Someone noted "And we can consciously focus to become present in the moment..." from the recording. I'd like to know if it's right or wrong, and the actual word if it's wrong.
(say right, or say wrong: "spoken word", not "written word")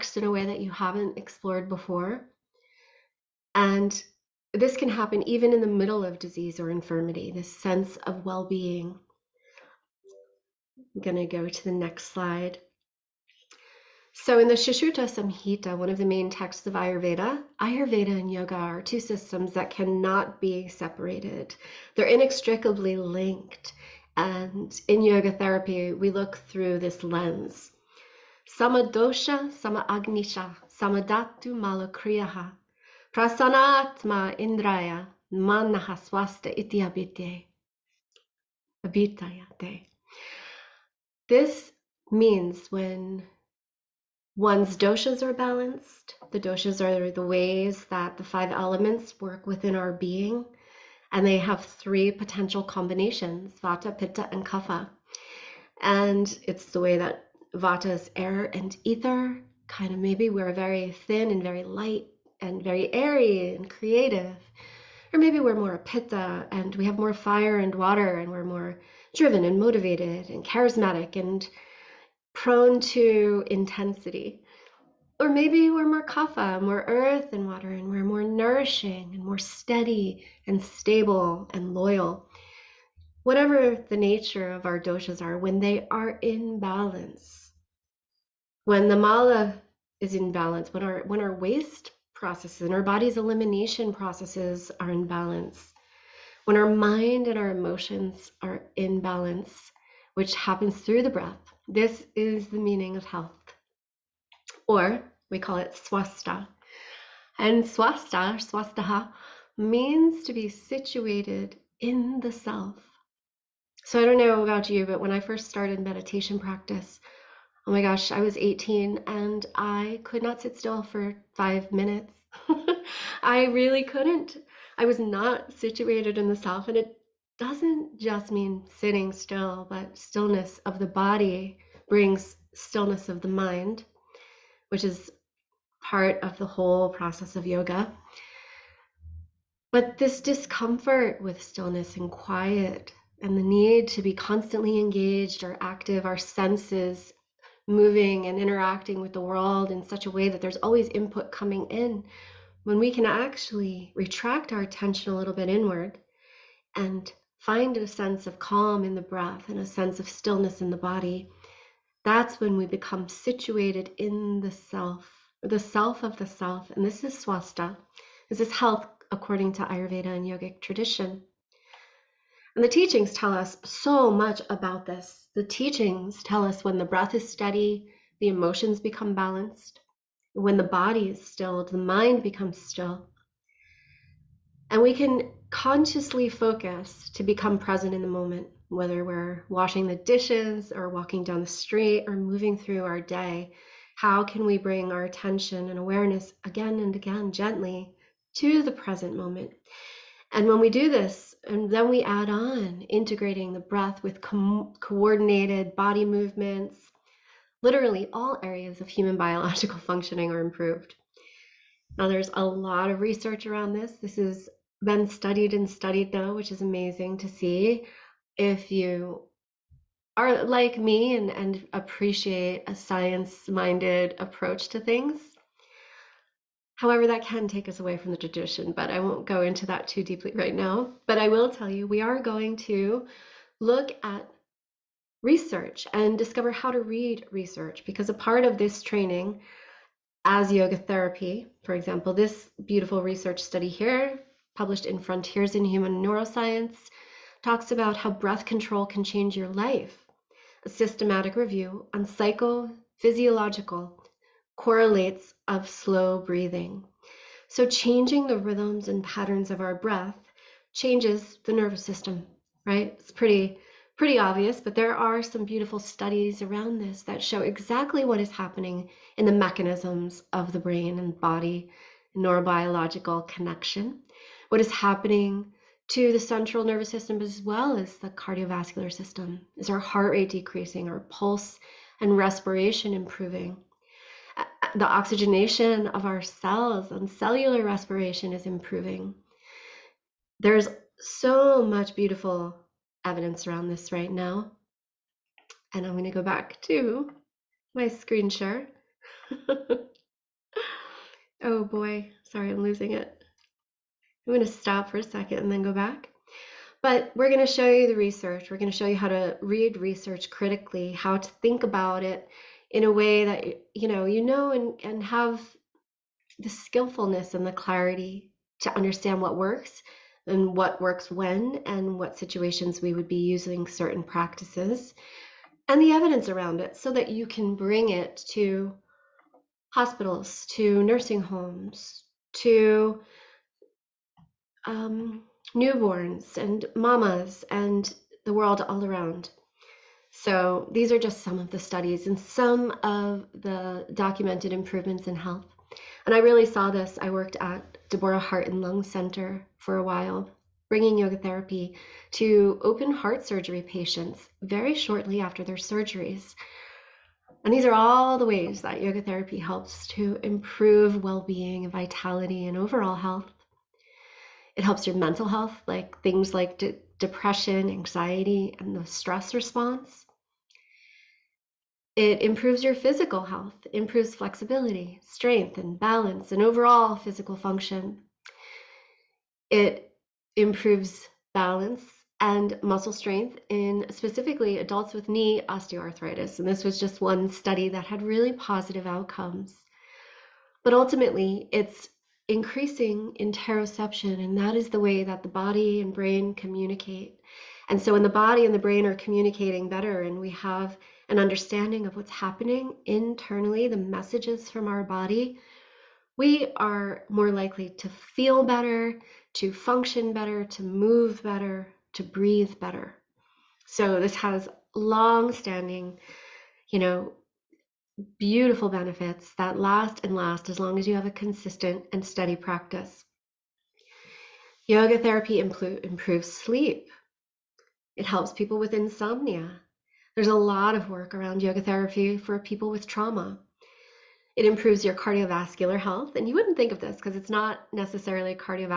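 right.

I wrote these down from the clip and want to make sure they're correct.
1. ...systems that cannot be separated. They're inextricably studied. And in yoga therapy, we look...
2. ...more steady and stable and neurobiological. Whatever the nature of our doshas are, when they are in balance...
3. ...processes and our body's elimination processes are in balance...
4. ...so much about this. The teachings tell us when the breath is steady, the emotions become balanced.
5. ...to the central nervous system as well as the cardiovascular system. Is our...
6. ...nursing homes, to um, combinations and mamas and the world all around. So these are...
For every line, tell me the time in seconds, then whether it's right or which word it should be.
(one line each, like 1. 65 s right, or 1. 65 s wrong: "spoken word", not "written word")
1. 18 s wrong: "linked", not "studied"
2. 79 s wrong: "loyal", not "neurobiological"
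3. 92 s right
4. 173 s right
5. 275 s right
6. 330 s wrong: "newborns", not "combinations".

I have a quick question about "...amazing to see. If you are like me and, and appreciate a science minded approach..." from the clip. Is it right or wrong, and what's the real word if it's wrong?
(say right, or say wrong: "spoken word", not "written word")
right.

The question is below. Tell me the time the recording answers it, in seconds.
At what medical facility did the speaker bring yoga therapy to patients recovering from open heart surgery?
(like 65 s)
347 s.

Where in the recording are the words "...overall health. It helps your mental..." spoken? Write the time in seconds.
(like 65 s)
362 s.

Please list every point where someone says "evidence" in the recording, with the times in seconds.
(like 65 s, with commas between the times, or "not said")
293 s, 325 s.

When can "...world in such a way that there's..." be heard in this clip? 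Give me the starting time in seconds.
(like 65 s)
149 s.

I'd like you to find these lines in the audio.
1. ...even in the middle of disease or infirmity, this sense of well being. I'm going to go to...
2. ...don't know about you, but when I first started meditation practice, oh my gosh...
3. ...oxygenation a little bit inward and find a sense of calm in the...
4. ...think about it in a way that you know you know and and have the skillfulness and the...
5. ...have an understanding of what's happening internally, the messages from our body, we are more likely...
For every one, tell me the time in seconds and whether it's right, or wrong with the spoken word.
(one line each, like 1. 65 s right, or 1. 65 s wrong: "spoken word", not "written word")
1. 5 s right
2. 114 s right
3. 154 s wrong: "attention", not "oxygenation"
4. 311 s right
5. 400 s right.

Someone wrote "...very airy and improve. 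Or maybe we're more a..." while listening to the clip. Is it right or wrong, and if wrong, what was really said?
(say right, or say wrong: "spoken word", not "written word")
wrong: "creative", not "improve".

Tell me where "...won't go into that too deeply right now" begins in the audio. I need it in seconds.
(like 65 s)
229 s.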